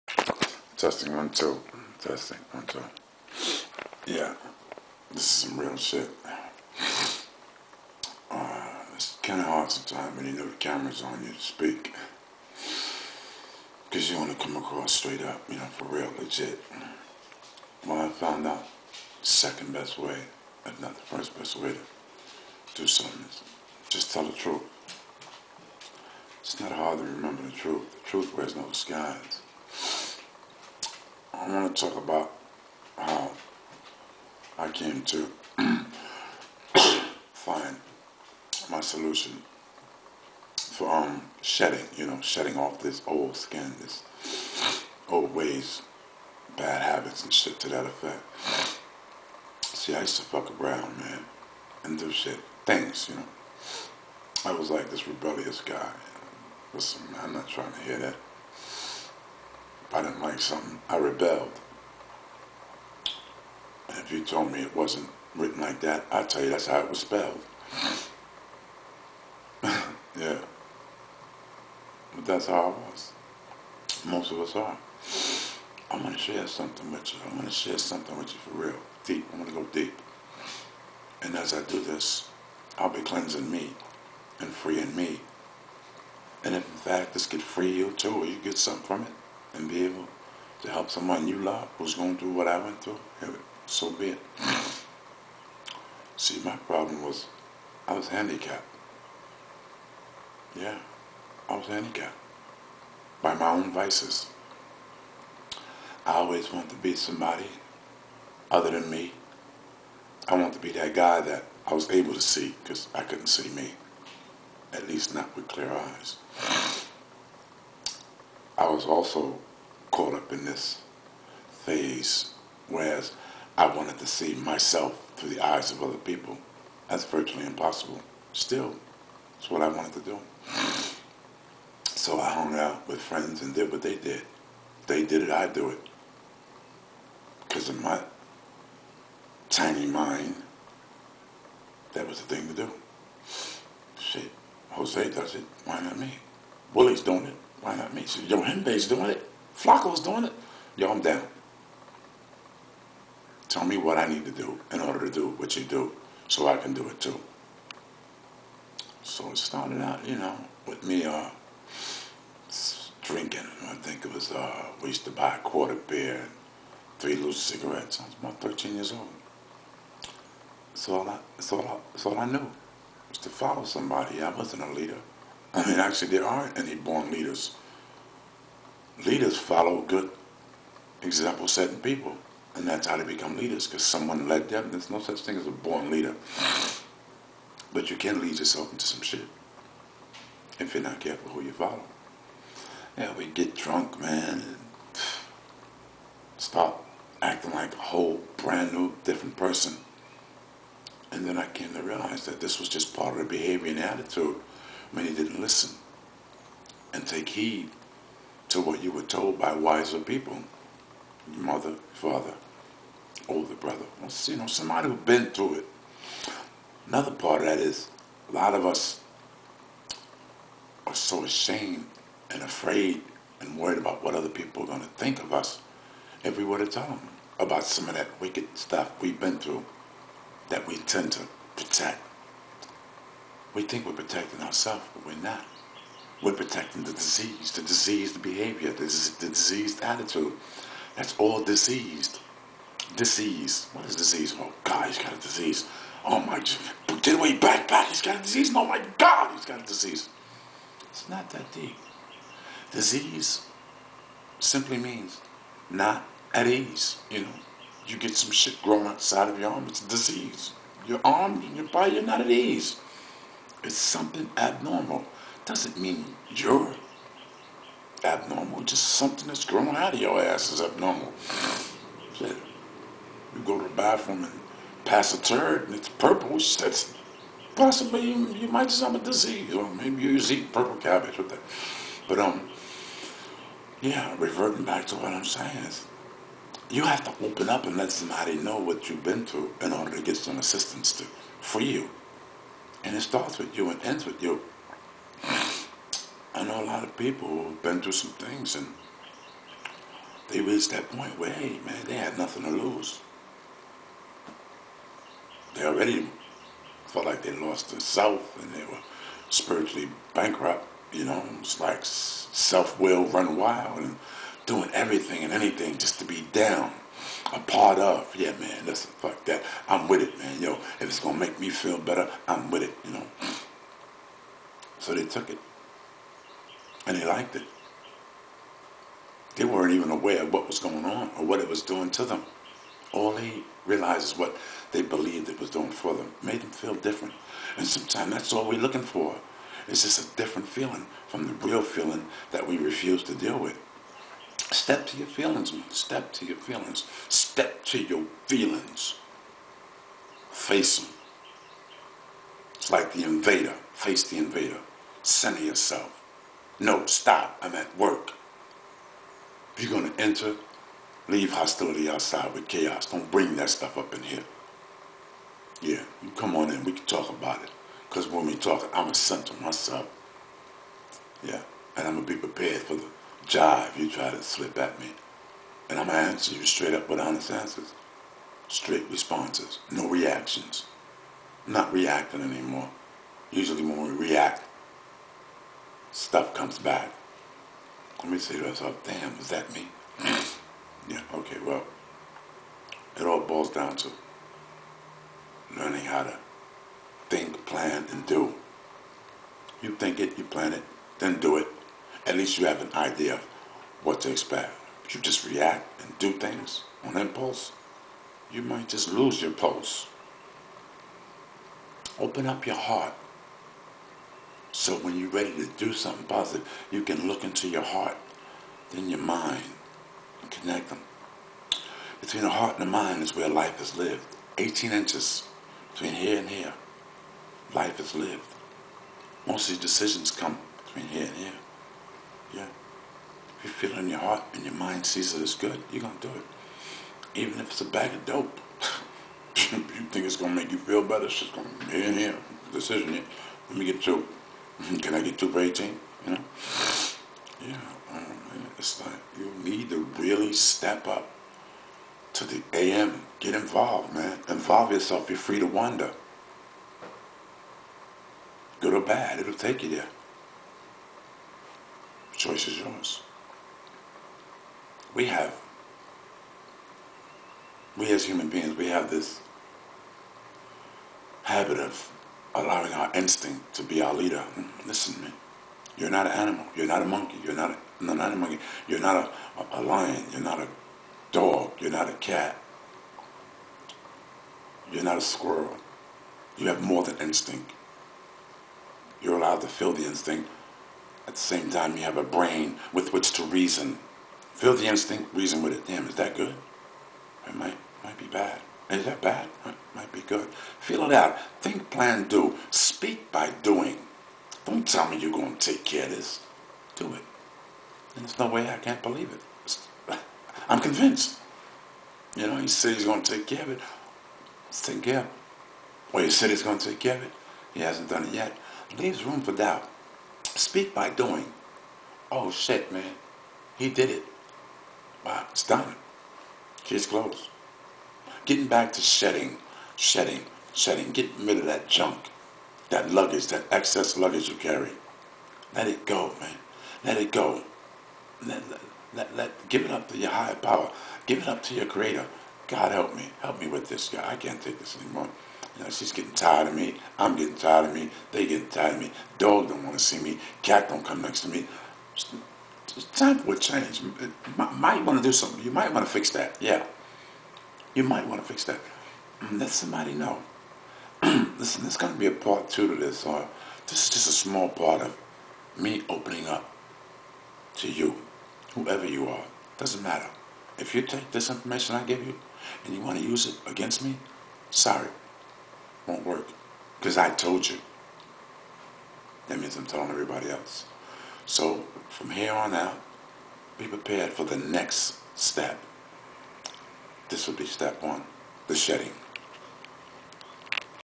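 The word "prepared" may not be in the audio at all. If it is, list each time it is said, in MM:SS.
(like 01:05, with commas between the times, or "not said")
06:12, 09:43.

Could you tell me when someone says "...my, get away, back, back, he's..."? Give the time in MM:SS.
04:06.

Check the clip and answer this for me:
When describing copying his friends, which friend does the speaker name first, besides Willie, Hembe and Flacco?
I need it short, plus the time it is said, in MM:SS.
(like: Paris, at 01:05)
Jose, at 02:24.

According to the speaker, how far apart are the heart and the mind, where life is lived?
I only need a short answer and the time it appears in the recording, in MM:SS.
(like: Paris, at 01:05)
18 inches, at 07:04.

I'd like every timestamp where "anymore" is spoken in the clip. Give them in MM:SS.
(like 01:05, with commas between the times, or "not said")
06:22, 09:04.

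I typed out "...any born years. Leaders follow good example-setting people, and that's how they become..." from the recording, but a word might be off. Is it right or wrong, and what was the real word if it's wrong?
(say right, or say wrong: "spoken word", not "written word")
wrong: "leaders", not "years".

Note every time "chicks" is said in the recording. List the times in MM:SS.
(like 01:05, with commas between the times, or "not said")
not said.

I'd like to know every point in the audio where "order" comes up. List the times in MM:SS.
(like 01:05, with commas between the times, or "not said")
02:34, 04:49.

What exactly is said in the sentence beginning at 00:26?
It's not hard to remember the truth.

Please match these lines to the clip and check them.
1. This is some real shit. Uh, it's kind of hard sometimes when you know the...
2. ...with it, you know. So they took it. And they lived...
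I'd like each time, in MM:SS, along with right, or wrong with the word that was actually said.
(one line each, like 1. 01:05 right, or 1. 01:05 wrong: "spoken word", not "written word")
1. 00:05 right
2. 05:22 wrong: "liked", not "lived".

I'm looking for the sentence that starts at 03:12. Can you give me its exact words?
Yeah, we get drunk, man, and start acting like a whole brand new, different person.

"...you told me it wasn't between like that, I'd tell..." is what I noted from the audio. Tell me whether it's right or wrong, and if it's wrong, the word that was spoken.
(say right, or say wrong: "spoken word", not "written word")
wrong: "written", not "between".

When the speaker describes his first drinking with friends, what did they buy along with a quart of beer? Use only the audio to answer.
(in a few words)
3 loose cigarettes.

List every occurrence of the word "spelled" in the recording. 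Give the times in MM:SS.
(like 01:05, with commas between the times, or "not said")
01:06.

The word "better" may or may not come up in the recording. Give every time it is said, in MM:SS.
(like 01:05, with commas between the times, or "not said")
05:21, 07:20.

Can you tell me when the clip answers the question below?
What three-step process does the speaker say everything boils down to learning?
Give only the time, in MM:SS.
06:37.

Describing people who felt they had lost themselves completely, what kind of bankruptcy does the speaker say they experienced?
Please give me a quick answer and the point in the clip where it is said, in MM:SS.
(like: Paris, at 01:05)
spiritually bankrupt, at 05:09.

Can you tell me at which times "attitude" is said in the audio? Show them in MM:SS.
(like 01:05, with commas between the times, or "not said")
03:23, 03:59.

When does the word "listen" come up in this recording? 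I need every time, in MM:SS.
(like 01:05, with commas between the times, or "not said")
00:56, 03:25, 05:18, 07:54, 09:21.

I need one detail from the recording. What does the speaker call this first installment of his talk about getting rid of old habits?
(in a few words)
the shedding.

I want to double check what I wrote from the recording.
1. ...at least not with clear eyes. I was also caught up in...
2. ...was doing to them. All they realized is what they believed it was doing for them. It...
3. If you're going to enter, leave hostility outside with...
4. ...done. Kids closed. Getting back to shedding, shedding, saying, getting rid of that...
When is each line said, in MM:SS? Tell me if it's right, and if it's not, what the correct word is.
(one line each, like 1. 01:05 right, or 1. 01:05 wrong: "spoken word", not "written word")
1. 01:54 right
2. 05:31 right
3. 05:59 right
4. 08:45 wrong: "shedding", not "saying".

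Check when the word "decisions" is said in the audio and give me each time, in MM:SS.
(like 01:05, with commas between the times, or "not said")
07:09, 07:22.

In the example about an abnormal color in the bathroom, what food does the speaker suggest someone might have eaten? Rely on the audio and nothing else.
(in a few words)
purple cabbage.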